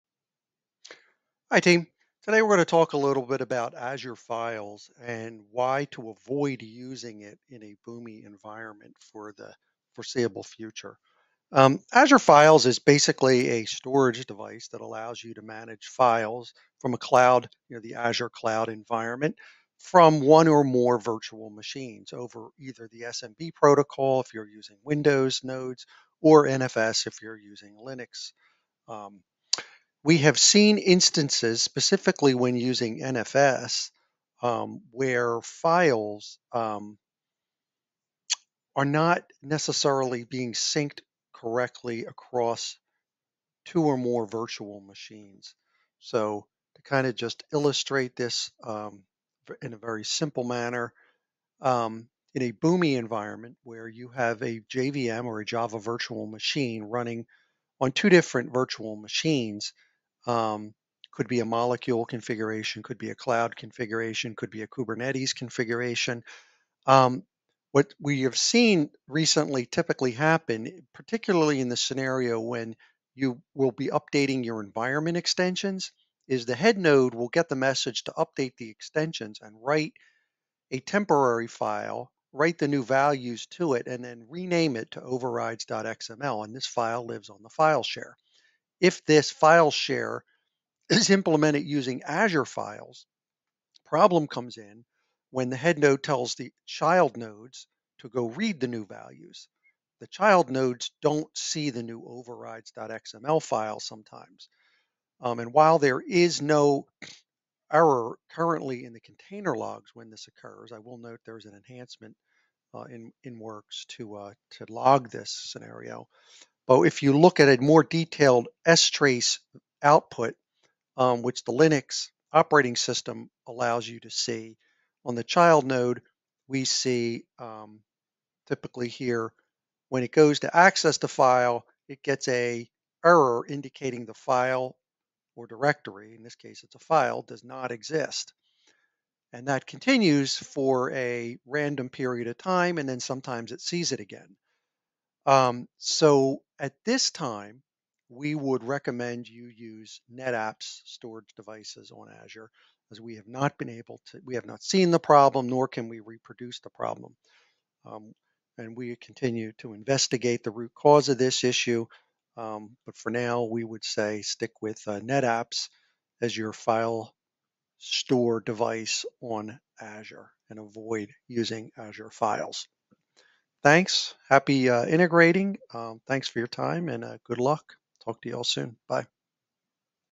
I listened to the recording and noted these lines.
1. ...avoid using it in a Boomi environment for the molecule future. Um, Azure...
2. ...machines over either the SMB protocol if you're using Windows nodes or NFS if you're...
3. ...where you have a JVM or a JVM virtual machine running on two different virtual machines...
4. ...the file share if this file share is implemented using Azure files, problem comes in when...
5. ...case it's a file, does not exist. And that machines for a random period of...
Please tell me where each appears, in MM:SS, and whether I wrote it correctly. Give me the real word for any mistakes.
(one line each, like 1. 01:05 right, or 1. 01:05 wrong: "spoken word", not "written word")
1. 00:06 wrong: "foreseeable", not "molecule"
2. 00:21 right
3. 00:53 wrong: "Java", not "JVM"
4. 01:27 right
5. 02:16 wrong: "continues", not "machines".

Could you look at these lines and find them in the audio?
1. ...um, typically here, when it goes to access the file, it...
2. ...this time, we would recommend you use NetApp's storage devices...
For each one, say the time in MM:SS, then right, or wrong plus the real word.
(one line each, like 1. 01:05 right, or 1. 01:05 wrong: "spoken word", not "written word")
1. 02:07 right
2. 02:26 right.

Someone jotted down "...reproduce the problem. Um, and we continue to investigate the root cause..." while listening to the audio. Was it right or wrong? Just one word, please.
right.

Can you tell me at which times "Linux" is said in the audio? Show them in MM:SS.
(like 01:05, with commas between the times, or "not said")
00:27, 02:01.